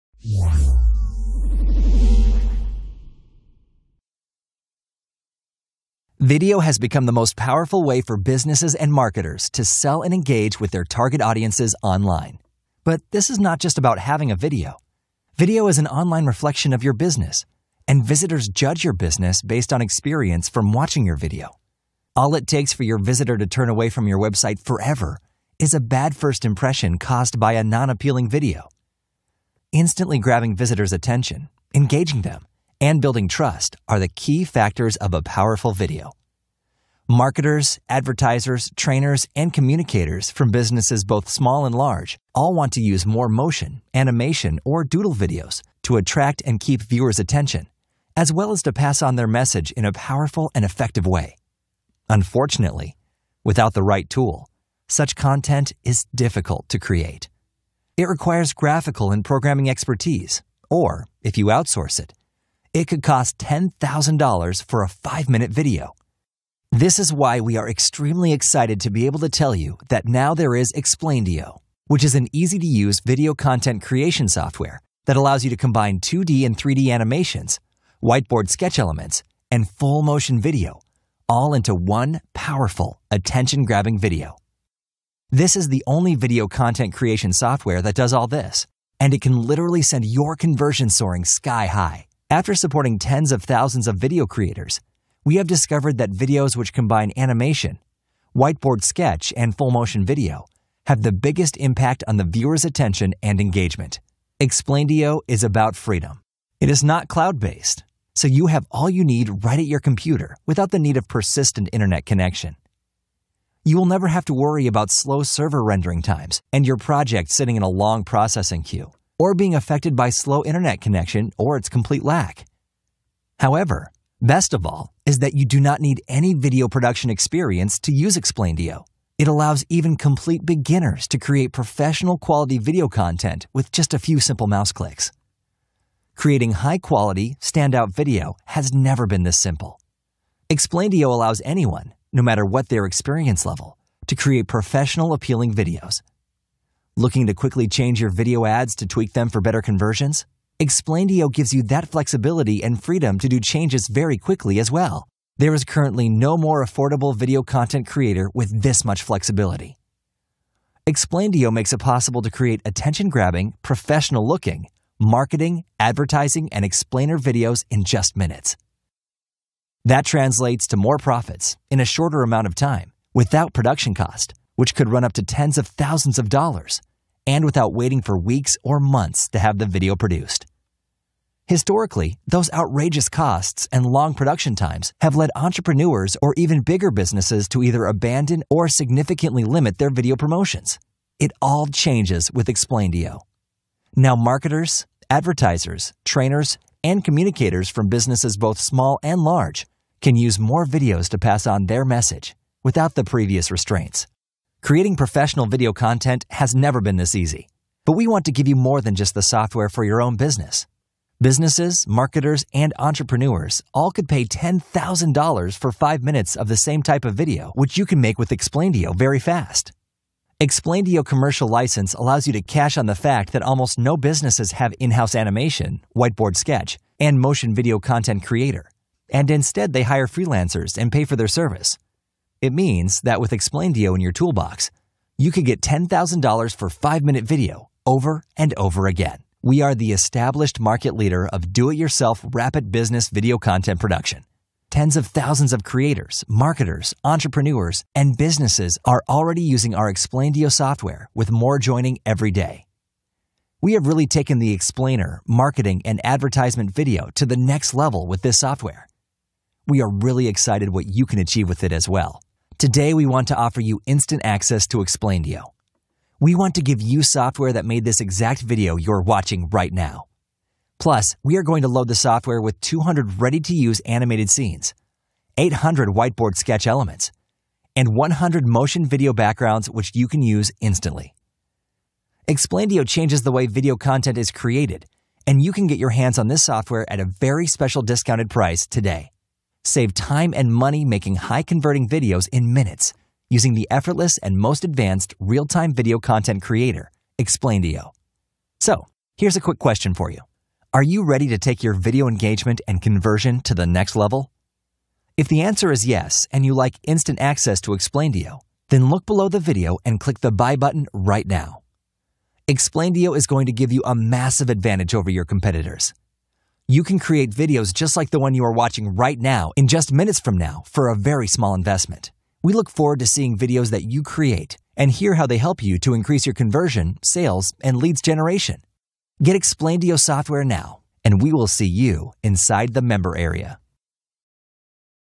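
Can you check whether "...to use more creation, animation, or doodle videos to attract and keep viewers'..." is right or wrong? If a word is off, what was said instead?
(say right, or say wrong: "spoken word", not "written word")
wrong: "motion", not "creation".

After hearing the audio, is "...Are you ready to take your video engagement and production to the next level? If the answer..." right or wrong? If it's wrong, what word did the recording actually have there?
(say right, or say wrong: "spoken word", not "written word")
wrong: "conversion", not "production".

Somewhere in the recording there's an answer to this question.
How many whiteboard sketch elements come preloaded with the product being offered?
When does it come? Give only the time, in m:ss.
4:35.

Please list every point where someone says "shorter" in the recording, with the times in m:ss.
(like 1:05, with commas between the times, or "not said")
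2:51.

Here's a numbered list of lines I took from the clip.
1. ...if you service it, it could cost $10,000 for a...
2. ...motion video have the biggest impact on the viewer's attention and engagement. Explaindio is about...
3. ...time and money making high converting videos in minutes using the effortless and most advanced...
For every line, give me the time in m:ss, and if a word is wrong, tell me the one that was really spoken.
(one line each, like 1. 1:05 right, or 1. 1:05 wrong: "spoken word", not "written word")
1. 1:01 wrong: "outsource", not "service"
2. 1:39 right
3. 4:49 right.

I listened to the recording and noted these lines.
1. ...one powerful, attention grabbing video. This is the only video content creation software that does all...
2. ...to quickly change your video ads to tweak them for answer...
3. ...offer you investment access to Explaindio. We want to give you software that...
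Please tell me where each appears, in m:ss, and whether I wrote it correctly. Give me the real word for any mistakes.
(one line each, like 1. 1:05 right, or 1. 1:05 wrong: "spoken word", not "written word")
1. 1:21 right
2. 2:27 wrong: "better", not "answer"
3. 4:23 wrong: "instant", not "investment".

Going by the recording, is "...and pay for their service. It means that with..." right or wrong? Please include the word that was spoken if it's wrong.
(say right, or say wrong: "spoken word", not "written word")
right.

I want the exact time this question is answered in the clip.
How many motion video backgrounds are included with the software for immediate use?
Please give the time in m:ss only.
4:37.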